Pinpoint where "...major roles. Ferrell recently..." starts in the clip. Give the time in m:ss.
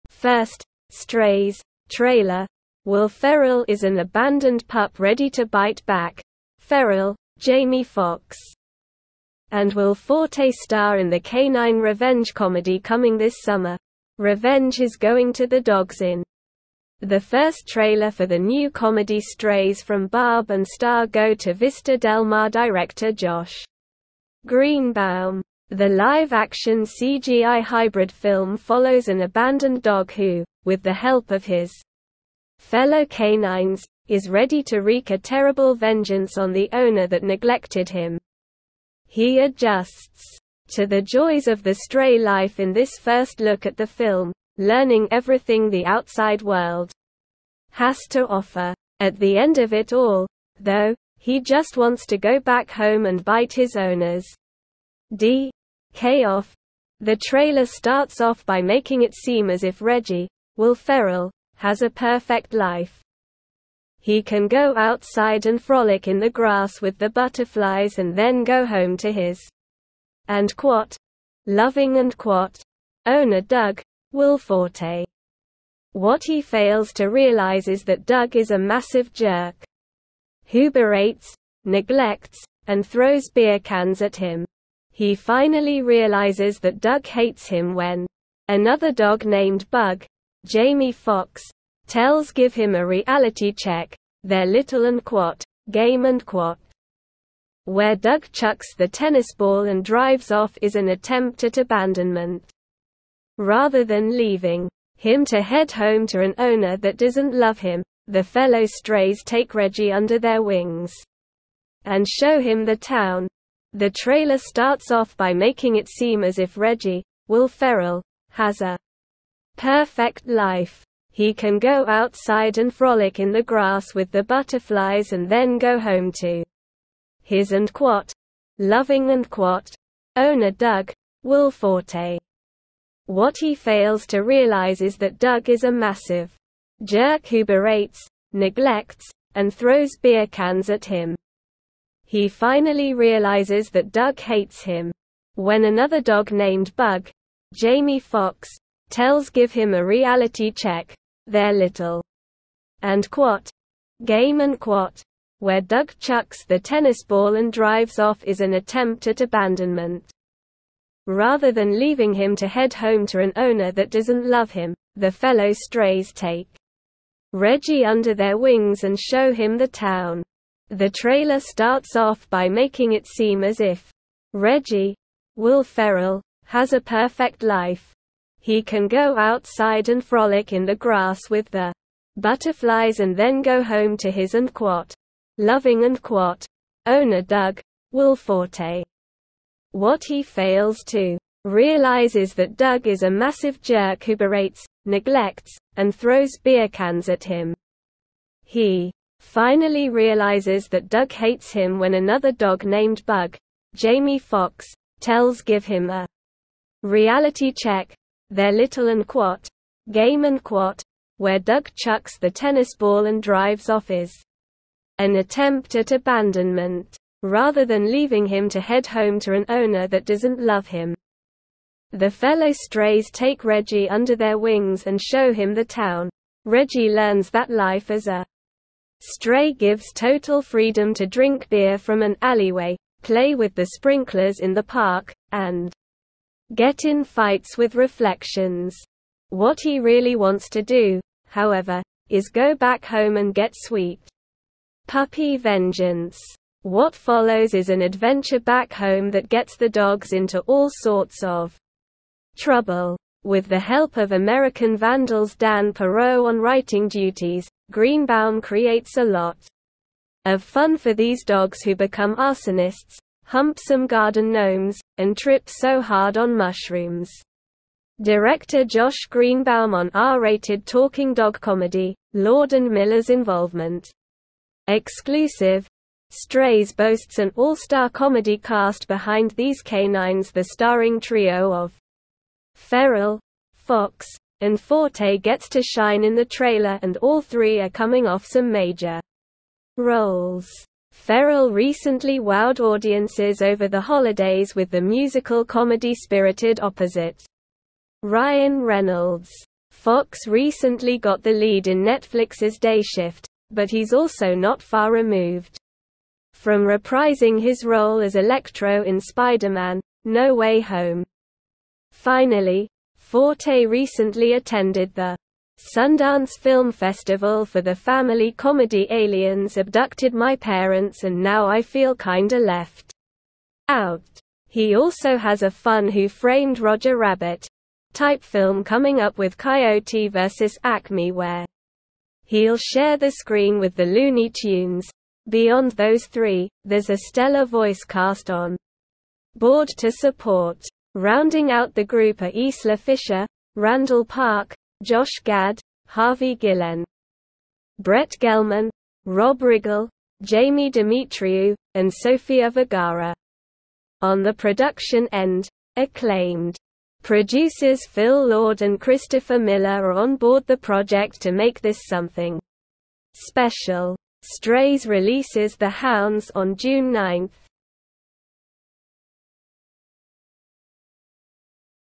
4:48.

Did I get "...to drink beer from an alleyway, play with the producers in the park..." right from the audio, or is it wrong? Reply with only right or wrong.
wrong.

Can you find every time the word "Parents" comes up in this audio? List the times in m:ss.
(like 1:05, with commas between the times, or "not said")
5:20.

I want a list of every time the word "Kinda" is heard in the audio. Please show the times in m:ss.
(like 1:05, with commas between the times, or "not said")
5:21.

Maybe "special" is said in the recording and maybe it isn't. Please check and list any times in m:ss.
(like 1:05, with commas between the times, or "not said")
6:03.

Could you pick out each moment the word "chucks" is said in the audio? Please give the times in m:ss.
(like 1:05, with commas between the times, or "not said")
1:38, 2:35, 3:31.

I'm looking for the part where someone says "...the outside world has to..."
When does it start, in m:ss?
0:45.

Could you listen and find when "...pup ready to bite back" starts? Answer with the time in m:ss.
0:04.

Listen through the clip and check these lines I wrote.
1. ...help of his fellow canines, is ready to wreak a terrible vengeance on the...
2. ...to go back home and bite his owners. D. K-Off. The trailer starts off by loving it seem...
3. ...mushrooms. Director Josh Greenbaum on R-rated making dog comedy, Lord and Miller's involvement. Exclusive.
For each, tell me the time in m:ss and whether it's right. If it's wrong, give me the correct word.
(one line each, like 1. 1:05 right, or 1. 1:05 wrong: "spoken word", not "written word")
1. 0:30 right
2. 0:52 wrong: "making", not "loving"
3. 4:26 wrong: "talking", not "making".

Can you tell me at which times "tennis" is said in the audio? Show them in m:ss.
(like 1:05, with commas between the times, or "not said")
1:38, 2:36, 3:32.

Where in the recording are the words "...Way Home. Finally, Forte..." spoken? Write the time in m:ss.
5:10.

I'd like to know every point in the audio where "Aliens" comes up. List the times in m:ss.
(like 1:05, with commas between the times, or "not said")
5:18.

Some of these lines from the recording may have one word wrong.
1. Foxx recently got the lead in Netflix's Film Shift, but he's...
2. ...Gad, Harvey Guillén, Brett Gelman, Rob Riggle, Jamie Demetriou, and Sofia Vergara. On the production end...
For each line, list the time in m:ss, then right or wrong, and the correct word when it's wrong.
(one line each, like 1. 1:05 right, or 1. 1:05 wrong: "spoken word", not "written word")
1. 4:59 wrong: "Day", not "Film"
2. 5:45 right.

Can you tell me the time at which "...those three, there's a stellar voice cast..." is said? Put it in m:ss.
5:35.